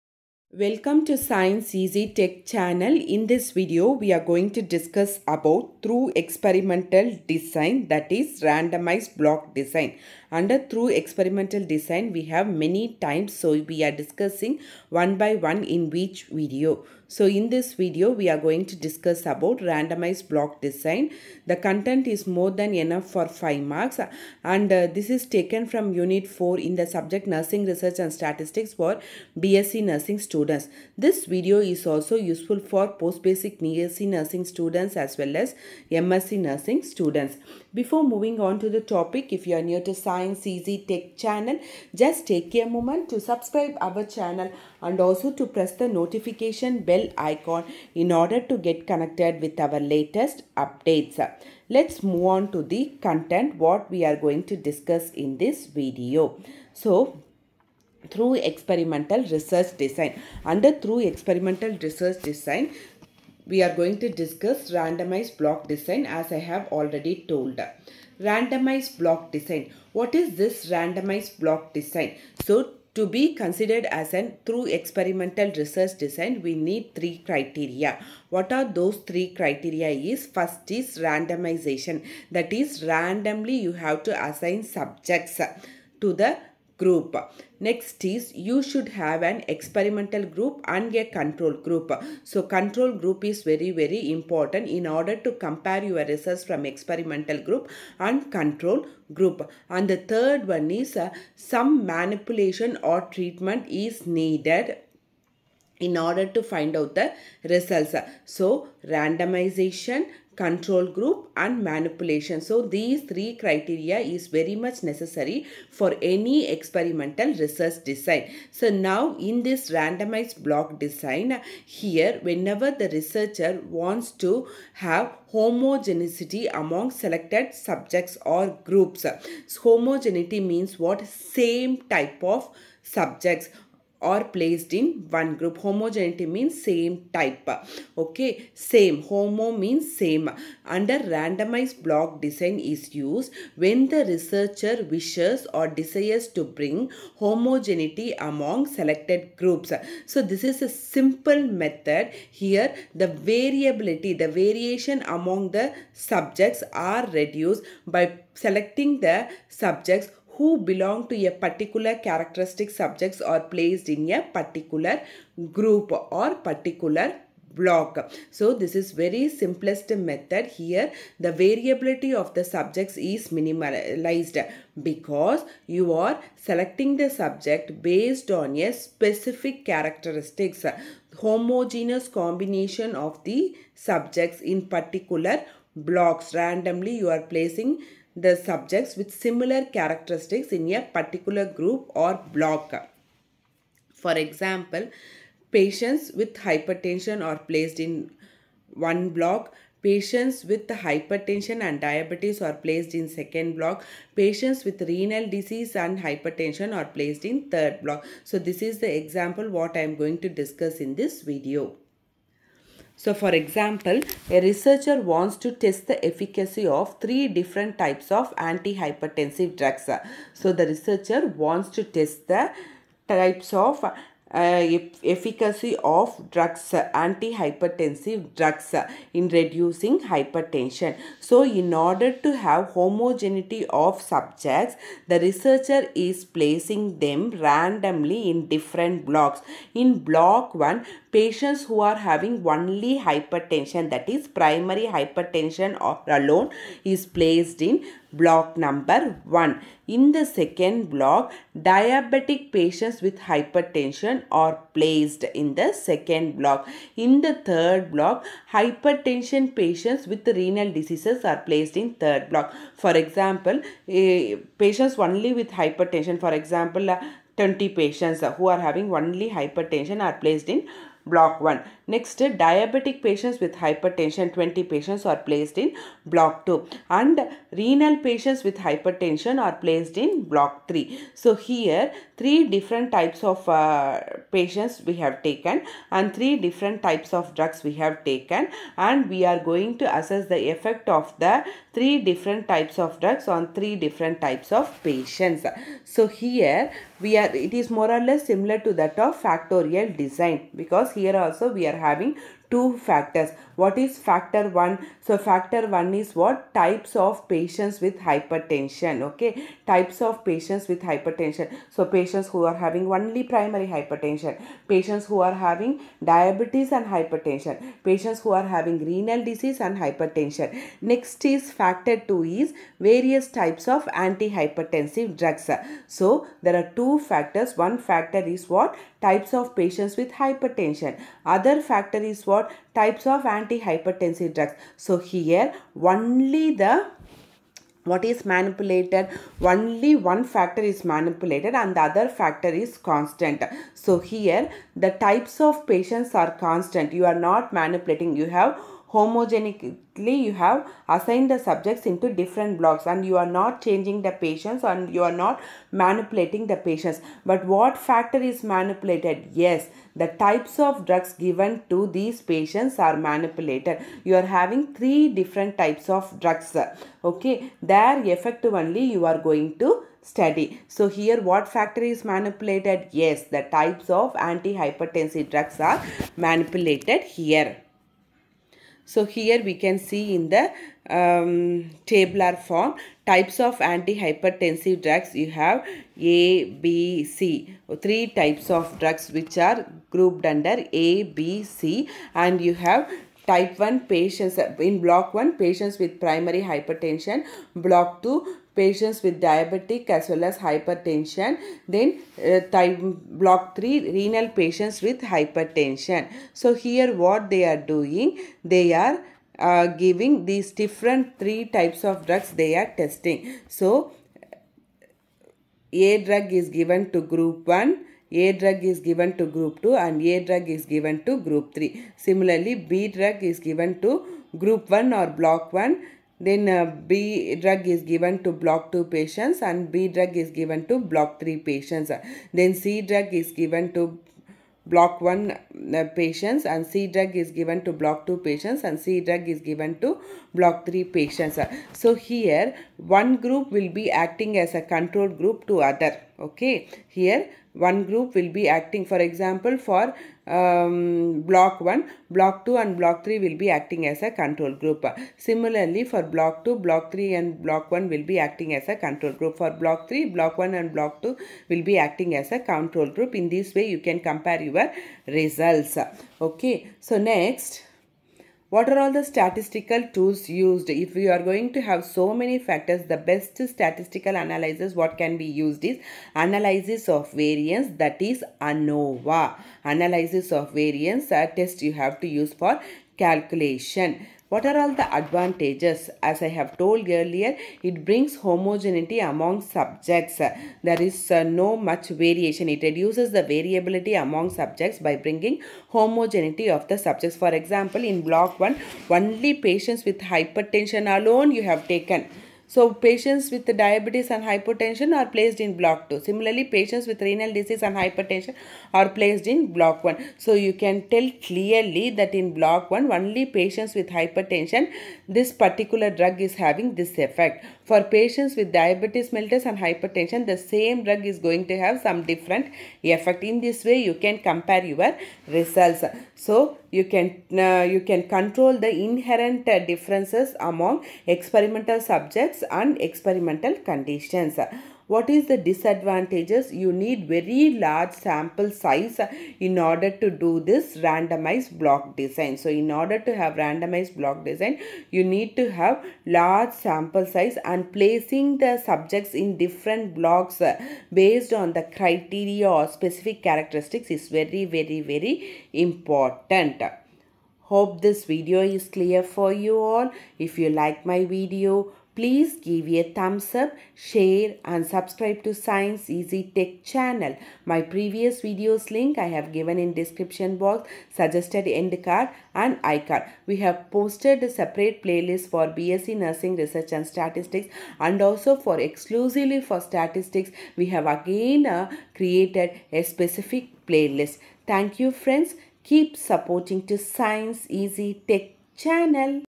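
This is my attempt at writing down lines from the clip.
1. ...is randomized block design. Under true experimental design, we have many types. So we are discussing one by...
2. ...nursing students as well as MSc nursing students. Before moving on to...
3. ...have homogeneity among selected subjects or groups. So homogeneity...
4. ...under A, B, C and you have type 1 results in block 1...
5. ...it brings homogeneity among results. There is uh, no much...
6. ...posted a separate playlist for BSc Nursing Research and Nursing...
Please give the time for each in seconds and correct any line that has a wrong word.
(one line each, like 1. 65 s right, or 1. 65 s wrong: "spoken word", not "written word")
1. 8 s right
2. 34 s right
3. 124 s right
4. 390 s wrong: "patients", not "results"
5. 487 s wrong: "subjects", not "results"
6. 573 s wrong: "Statistics", not "Nursing".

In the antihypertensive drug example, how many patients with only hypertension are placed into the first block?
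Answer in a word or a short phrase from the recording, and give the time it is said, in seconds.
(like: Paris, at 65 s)
20, at 267 s.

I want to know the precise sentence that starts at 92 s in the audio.
So control group is very very important in order to compare your results from experimental group and control group.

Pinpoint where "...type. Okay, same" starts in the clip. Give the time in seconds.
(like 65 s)
137 s.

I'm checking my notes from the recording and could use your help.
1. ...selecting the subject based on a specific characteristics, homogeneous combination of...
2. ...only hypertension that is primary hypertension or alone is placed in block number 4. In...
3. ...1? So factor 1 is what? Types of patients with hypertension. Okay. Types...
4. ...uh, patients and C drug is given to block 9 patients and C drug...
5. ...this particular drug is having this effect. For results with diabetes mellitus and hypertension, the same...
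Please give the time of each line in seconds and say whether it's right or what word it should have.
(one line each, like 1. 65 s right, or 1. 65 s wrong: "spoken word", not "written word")
1. 176 s right
2. 242 s wrong: "1", not "4"
3. 304 s right
4. 435 s wrong: "2", not "9"
5. 515 s wrong: "patients", not "results".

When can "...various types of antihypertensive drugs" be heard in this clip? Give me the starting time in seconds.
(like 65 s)
322 s.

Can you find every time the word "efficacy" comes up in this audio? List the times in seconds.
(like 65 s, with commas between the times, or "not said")
216 s, 225 s.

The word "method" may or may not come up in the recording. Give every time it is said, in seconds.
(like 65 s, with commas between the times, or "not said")
151 s, 170 s.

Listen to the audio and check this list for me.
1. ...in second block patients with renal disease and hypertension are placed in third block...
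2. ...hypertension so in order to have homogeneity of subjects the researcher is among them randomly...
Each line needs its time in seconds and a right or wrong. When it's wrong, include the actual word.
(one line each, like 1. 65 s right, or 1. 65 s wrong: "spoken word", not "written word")
1. 202 s right
2. 230 s wrong: "placing", not "among".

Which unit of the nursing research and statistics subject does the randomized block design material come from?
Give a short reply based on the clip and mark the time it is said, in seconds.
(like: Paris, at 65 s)
Unit 4, at 25 s.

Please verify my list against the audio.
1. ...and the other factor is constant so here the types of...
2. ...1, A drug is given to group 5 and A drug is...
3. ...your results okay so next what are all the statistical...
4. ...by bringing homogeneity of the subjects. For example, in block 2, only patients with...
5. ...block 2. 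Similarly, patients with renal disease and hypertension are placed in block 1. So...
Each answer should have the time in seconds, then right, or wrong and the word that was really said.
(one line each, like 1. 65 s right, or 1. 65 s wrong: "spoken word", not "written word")
1. 341 s right
2. 417 s wrong: "2", not "5"
3. 464 s right
4. 494 s wrong: "1", not "2"
5. 505 s right.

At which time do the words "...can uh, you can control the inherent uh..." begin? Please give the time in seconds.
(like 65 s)
526 s.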